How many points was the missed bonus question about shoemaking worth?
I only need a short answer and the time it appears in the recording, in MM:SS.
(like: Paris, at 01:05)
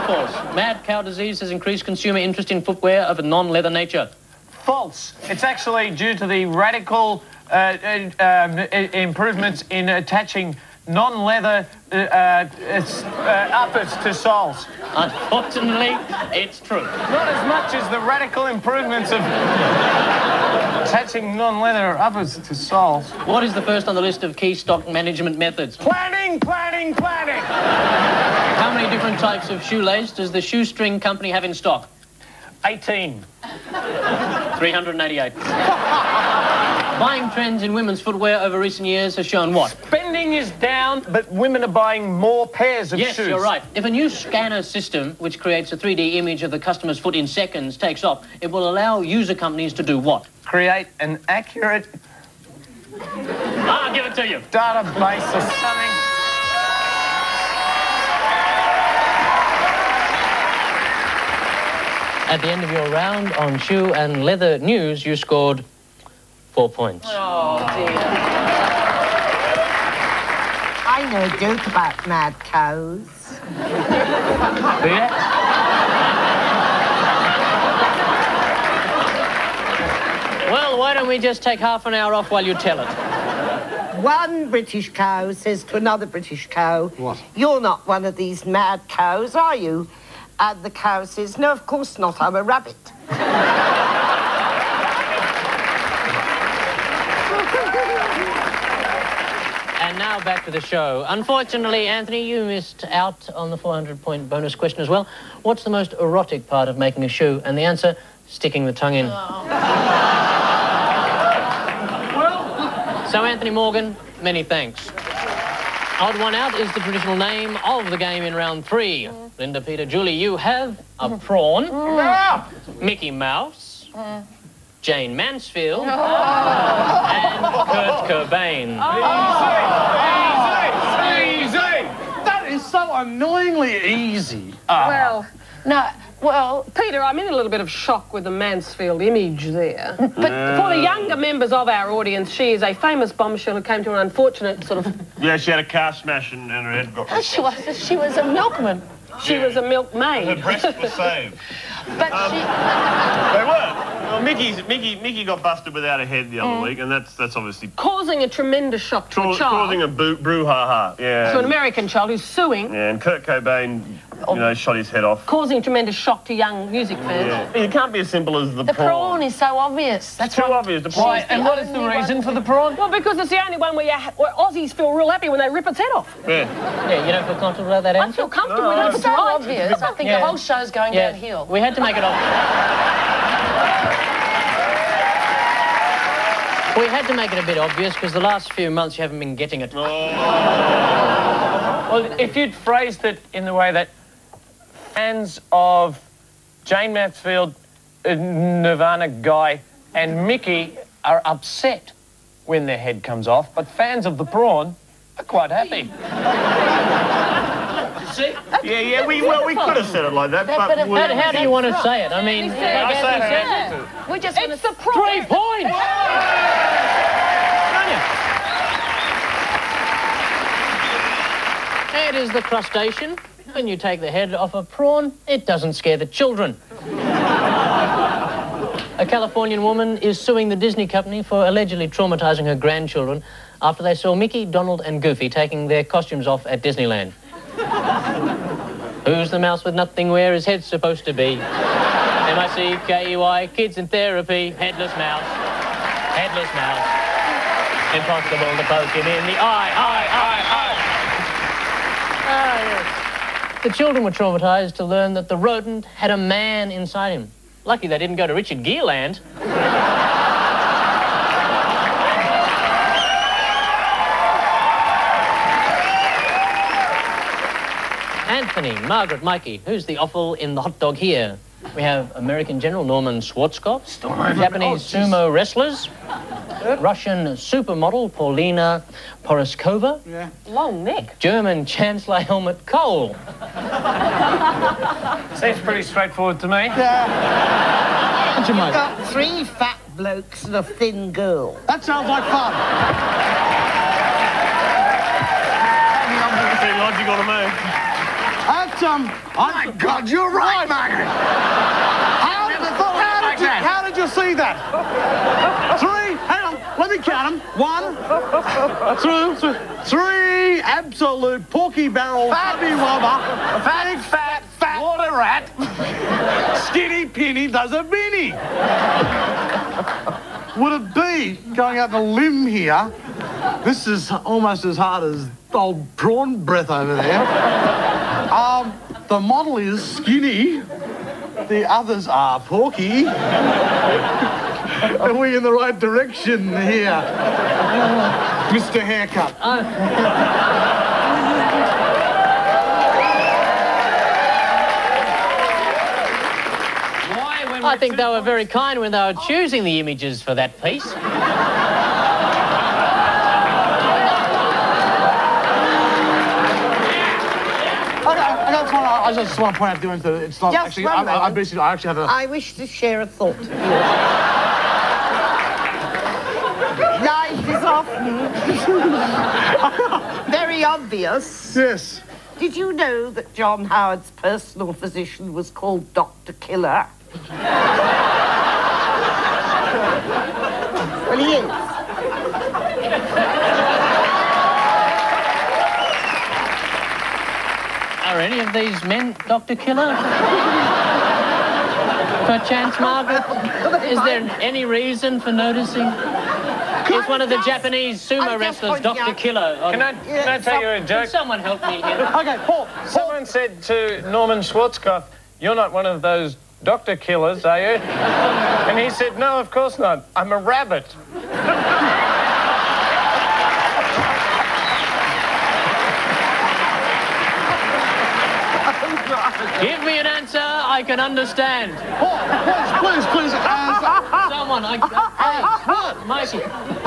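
400, at 01:43.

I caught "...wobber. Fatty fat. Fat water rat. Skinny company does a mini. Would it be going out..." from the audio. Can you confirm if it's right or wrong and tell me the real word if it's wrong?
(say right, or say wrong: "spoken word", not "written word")
wrong: "penny", not "company".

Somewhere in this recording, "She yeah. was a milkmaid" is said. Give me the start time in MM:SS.
02:29.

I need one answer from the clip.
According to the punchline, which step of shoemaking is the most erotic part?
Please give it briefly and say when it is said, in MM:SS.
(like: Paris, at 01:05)
Sticking the tongue in, at 01:48.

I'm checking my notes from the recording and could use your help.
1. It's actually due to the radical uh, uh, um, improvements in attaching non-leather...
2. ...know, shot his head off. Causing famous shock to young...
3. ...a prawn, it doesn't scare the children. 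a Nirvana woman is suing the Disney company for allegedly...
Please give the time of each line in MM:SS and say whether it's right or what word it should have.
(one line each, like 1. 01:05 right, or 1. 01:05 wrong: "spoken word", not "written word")
1. 00:05 right
2. 02:44 wrong: "tremendous", not "famous"
3. 03:44 wrong: "Californian", not "Nirvana".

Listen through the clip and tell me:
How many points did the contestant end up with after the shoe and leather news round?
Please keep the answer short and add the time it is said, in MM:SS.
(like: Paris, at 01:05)
4, at 01:06.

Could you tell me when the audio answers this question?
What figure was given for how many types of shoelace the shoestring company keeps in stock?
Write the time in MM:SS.
00:33.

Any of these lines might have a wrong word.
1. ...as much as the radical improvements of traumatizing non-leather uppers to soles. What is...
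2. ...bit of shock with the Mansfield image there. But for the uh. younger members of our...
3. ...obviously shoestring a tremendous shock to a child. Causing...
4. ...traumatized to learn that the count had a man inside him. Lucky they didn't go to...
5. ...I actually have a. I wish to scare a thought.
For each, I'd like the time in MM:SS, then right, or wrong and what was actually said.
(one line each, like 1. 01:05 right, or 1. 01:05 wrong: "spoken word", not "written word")
1. 00:17 wrong: "attaching", not "traumatizing"
2. 02:17 right
3. 02:37 wrong: "causing", not "shoestring"
4. 04:14 wrong: "rodent", not "count"
5. 06:01 wrong: "share", not "scare".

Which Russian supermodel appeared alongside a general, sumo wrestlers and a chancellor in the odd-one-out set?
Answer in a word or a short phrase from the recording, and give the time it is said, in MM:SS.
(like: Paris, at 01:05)
Paulina Porizkova, at 04:38.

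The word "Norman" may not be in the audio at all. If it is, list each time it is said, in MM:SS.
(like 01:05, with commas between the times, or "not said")
04:32, 06:44.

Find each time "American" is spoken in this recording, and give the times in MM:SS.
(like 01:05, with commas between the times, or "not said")
02:41, 04:32.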